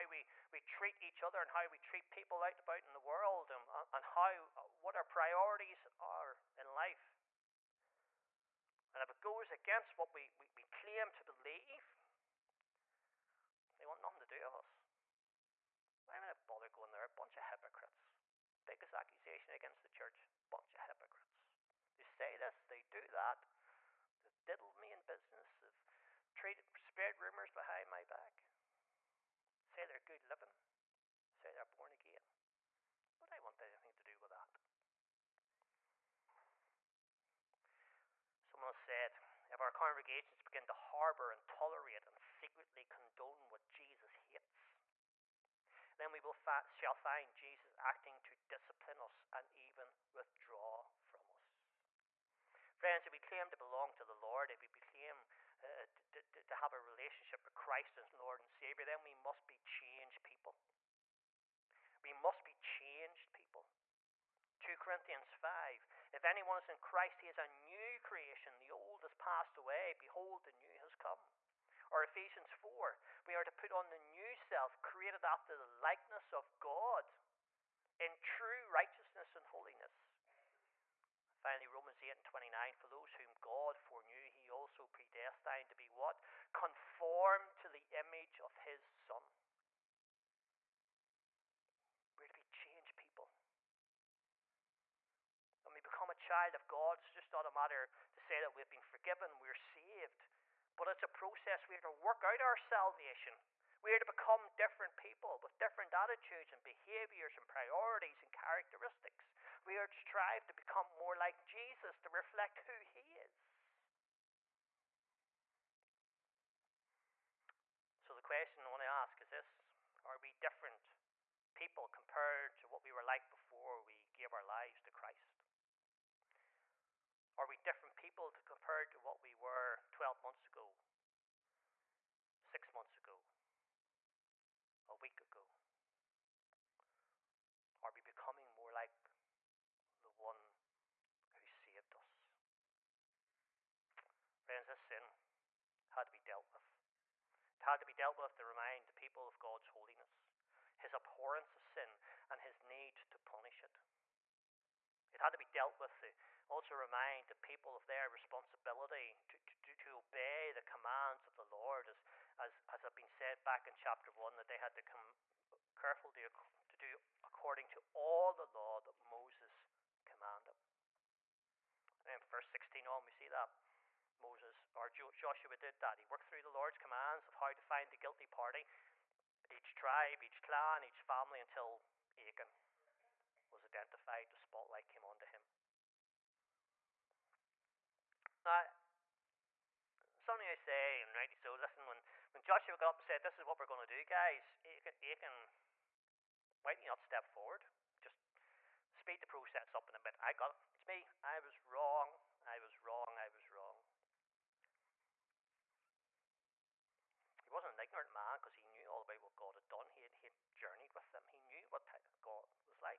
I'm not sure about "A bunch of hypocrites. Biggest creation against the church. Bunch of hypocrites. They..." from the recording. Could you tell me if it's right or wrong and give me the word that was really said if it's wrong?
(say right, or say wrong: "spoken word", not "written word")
wrong: "accusation", not "creation".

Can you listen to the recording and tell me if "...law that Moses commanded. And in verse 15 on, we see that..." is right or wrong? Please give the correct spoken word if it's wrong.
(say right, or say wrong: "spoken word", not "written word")
wrong: "16", not "15".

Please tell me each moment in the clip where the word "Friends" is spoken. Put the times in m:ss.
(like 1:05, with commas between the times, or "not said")
0:52, 2:24.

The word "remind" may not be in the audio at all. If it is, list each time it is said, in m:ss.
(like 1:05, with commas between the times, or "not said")
2:28, 2:36.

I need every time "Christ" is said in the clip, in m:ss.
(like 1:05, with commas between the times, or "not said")
0:57, 1:06, 2:04.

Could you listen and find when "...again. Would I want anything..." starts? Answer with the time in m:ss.
0:31.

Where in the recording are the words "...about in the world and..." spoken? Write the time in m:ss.
0:02.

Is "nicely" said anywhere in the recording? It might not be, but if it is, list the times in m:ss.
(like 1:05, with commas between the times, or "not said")
not said.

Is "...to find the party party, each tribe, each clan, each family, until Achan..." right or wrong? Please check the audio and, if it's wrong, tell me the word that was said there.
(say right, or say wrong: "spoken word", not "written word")
wrong: "guilty", not "party".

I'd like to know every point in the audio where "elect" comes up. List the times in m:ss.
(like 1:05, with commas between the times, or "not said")
not said.